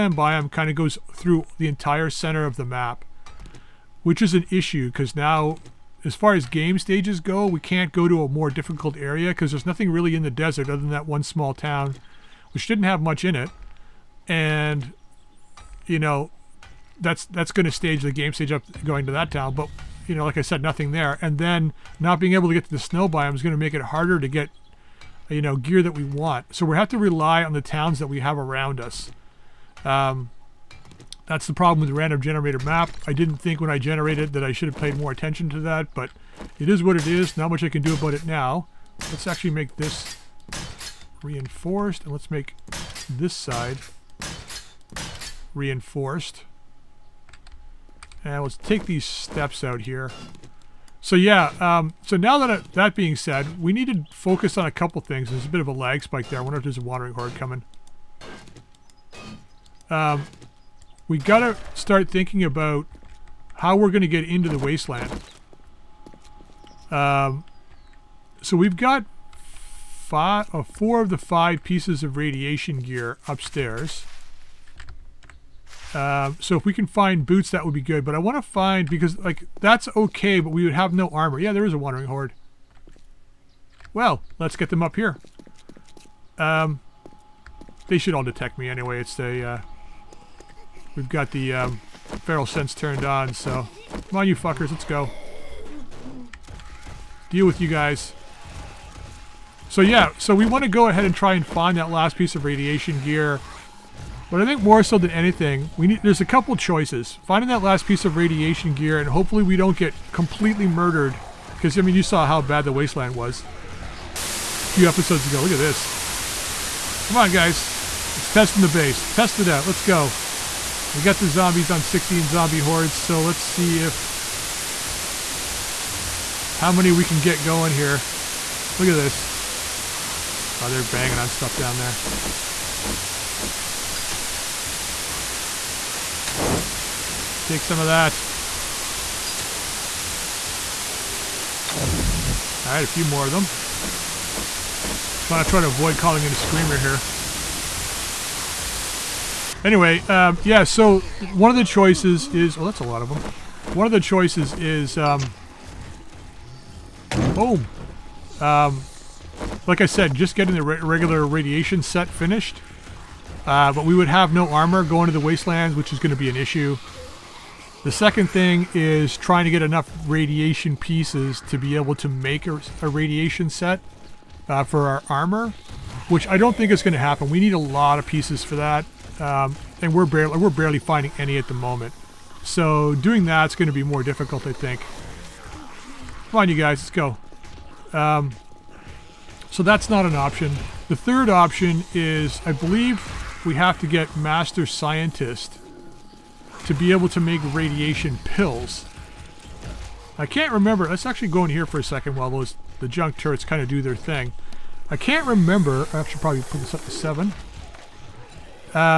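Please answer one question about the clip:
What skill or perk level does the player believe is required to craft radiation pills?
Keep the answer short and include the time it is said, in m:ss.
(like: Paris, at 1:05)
Master Scientist, at 3:14.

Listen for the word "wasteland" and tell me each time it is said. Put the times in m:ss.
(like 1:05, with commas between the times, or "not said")
1:04, 1:52, 2:45.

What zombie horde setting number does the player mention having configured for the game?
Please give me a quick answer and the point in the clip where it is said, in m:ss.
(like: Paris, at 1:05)
16, at 2:01.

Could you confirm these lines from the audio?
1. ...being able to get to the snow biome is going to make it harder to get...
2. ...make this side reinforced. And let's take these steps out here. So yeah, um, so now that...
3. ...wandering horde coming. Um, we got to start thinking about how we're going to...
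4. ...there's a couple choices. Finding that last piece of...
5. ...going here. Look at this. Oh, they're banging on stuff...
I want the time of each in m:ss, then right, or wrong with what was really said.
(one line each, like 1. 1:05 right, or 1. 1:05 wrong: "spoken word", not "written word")
1. 0:22 right
2. 0:42 right
3. 0:56 right
4. 1:46 right
5. 2:07 right.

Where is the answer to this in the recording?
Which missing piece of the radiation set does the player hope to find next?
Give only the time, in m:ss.
1:17.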